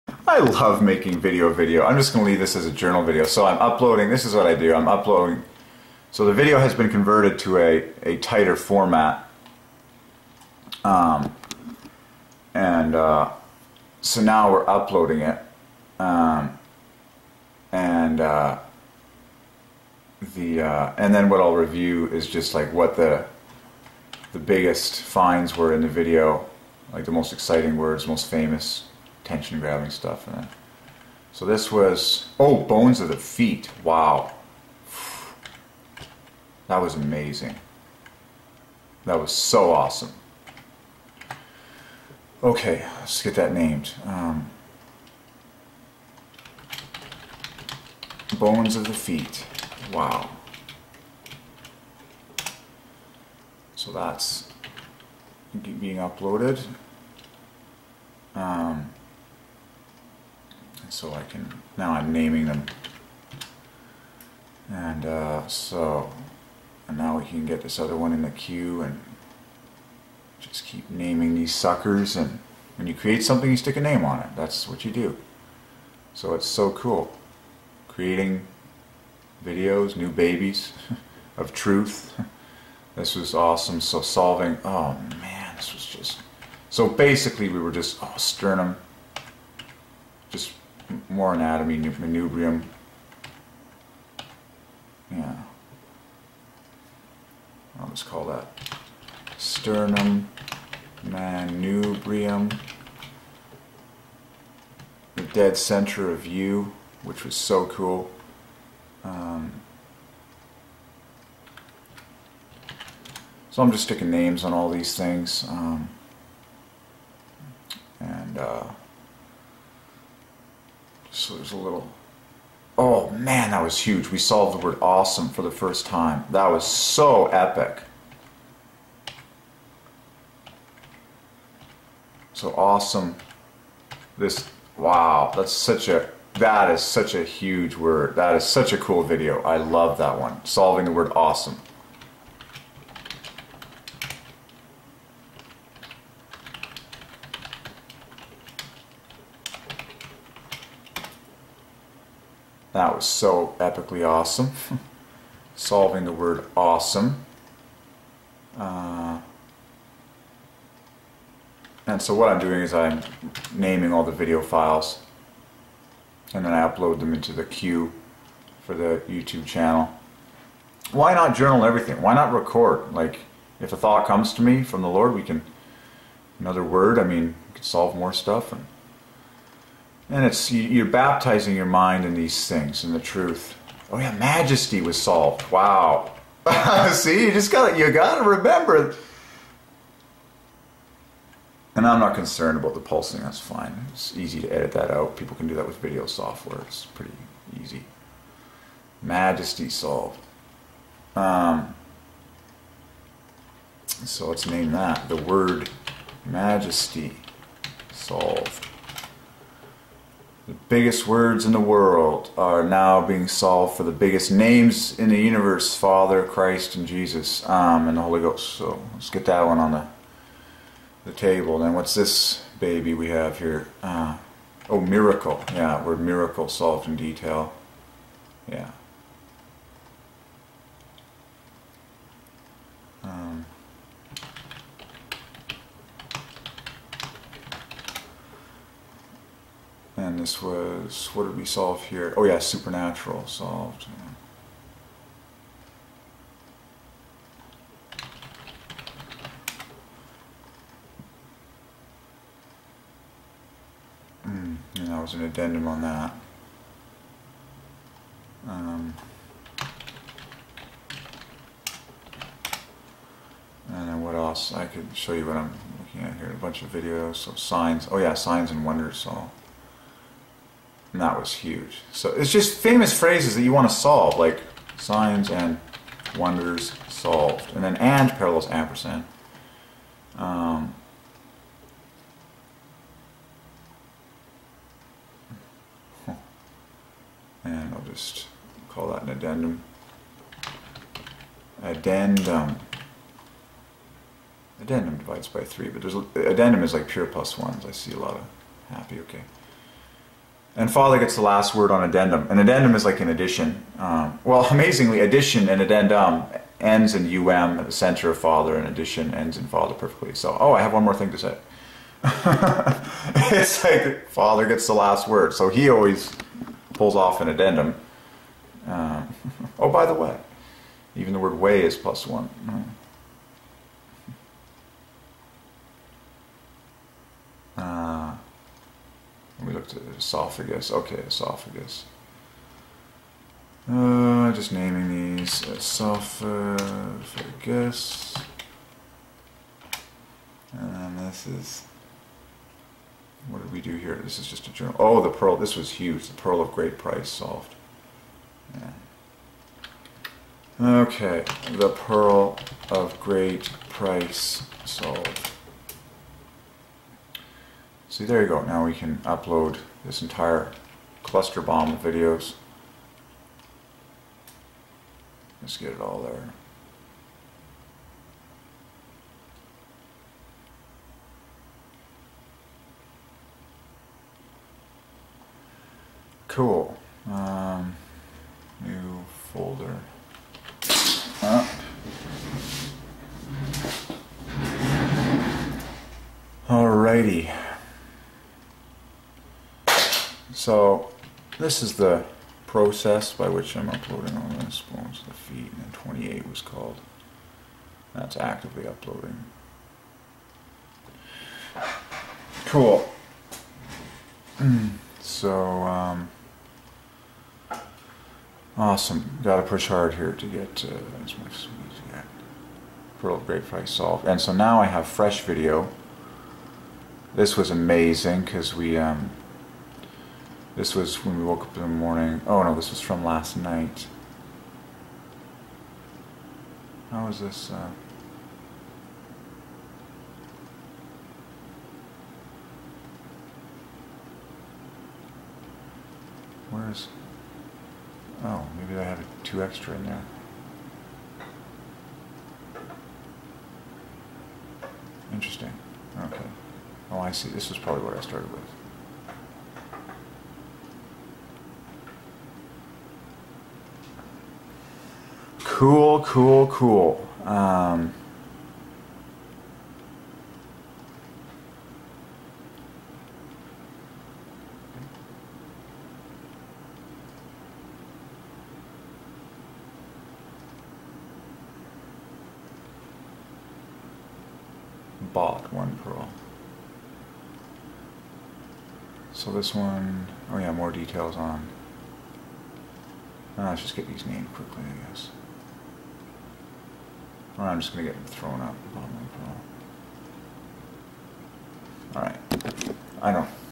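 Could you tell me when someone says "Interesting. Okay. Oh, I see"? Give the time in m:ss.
7:25.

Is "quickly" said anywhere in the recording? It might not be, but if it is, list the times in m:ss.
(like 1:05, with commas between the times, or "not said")
8:04.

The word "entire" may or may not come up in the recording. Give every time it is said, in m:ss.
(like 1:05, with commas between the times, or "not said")
6:00.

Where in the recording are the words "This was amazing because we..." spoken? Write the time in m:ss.
6:57.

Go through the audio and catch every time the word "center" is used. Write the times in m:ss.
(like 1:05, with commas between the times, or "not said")
1:45, 5:07.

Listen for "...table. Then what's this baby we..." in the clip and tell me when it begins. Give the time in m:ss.
3:41.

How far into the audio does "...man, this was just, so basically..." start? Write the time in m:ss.
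1:25.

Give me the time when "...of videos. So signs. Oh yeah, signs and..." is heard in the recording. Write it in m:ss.
4:26.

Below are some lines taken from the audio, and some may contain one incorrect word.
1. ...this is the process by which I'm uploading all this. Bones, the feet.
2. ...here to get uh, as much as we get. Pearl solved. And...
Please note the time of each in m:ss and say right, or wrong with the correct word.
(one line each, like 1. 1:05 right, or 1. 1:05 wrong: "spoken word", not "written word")
1. 6:31 right
2. 6:49 right.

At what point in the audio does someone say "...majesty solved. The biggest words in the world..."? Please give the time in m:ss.
3:26.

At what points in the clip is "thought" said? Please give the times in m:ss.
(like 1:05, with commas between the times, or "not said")
2:53.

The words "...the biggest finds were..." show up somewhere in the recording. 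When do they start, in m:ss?
0:24.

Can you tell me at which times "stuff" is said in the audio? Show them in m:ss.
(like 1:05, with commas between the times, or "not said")
0:29, 2:58.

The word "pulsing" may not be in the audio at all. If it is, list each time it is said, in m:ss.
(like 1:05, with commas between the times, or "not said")
3:12.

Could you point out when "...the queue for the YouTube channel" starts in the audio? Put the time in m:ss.
2:47.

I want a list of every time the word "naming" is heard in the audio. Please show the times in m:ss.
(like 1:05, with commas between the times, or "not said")
1:02, 1:10, 2:43, 5:34.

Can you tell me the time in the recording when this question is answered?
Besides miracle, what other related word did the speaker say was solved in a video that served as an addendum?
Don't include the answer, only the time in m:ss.
4:02.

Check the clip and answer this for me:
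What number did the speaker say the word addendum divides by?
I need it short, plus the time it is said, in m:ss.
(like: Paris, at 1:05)
3, at 4:55.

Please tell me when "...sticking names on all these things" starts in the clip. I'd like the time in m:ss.
1:53.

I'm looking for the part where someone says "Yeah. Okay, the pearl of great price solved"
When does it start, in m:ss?
5:48.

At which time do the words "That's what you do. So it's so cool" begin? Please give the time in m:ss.
1:14.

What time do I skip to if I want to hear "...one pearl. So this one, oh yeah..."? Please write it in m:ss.
7:55.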